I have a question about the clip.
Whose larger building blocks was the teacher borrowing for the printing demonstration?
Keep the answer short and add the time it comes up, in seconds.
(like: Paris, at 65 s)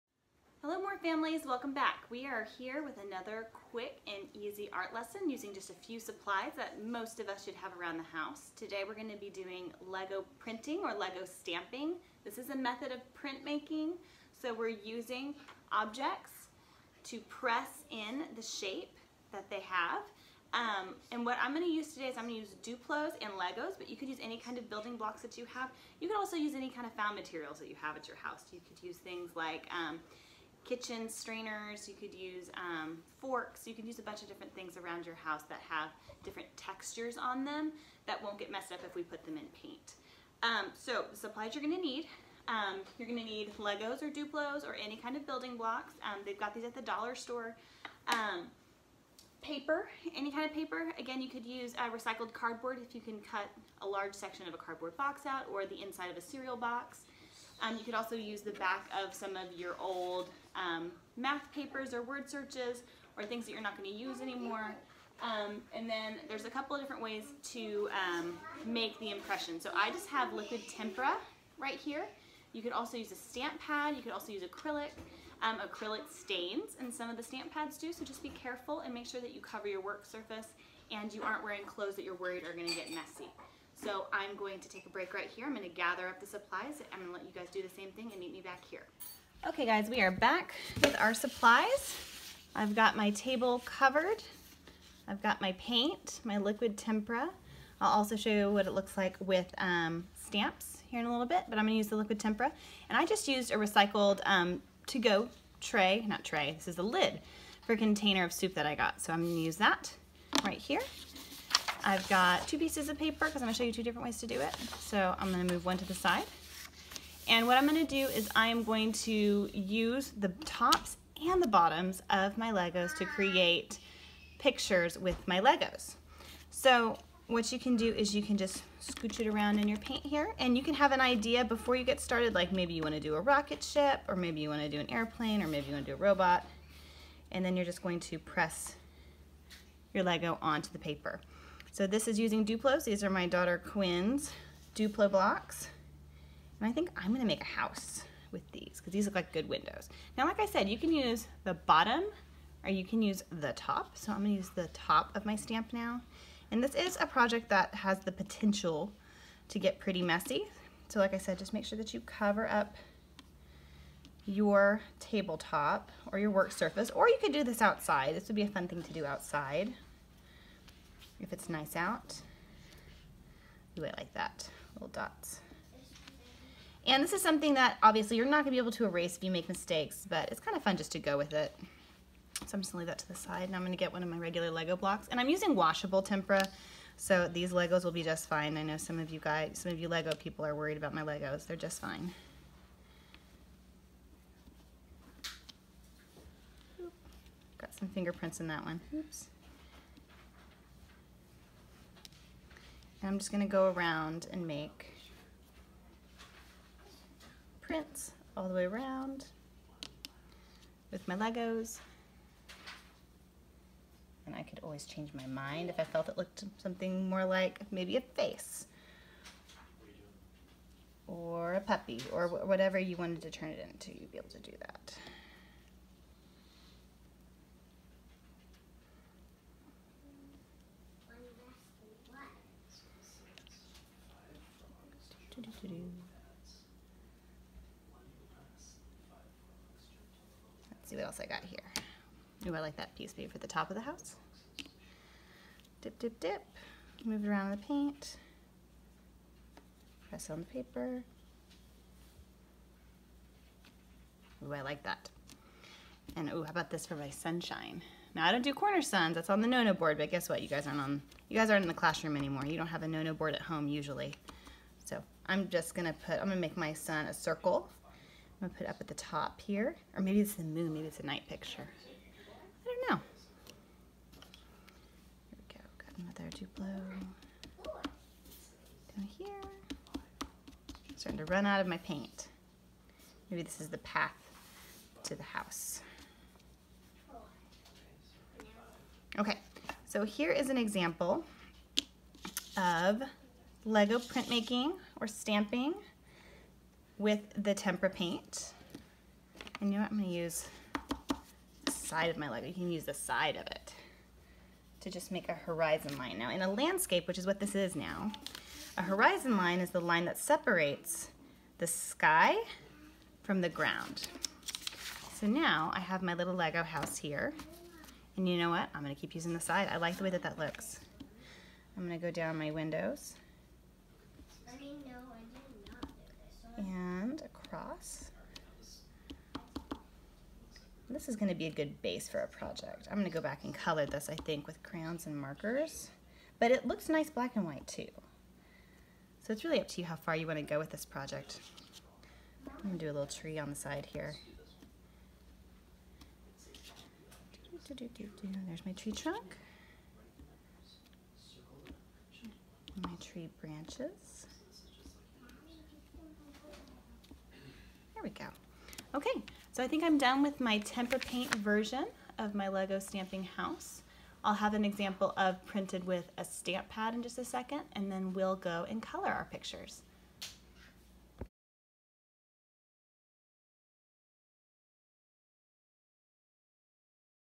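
Quinn, at 143 s.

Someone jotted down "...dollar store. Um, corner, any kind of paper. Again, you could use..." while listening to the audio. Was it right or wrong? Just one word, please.
wrong.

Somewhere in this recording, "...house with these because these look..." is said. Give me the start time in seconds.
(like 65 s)
147 s.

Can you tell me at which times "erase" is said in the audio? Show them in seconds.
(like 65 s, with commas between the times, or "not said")
178 s.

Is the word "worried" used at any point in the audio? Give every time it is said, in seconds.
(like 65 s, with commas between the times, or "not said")
82 s, 190 s.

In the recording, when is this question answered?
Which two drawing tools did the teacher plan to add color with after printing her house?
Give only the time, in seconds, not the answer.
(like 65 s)
334 s.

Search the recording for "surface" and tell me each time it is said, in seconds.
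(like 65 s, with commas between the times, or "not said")
80 s, 166 s.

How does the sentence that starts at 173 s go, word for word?
Do I like that, little dots.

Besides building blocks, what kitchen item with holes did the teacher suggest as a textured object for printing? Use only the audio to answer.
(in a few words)
Kitchen strainers.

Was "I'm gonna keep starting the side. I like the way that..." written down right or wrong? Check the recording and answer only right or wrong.
wrong.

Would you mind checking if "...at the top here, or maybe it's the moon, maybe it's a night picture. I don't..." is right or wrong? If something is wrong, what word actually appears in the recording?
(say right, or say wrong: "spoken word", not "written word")
right.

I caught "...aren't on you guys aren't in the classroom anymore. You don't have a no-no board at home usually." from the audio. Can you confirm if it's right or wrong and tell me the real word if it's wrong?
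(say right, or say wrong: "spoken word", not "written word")
right.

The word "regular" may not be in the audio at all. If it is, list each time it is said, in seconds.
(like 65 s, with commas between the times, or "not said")
184 s.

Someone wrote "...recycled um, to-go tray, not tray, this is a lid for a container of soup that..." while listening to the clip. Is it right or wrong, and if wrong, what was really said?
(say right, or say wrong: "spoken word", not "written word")
right.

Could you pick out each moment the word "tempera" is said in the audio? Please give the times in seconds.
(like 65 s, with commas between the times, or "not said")
70 s, 96 s, 102 s, 186 s, 297 s, 360 s.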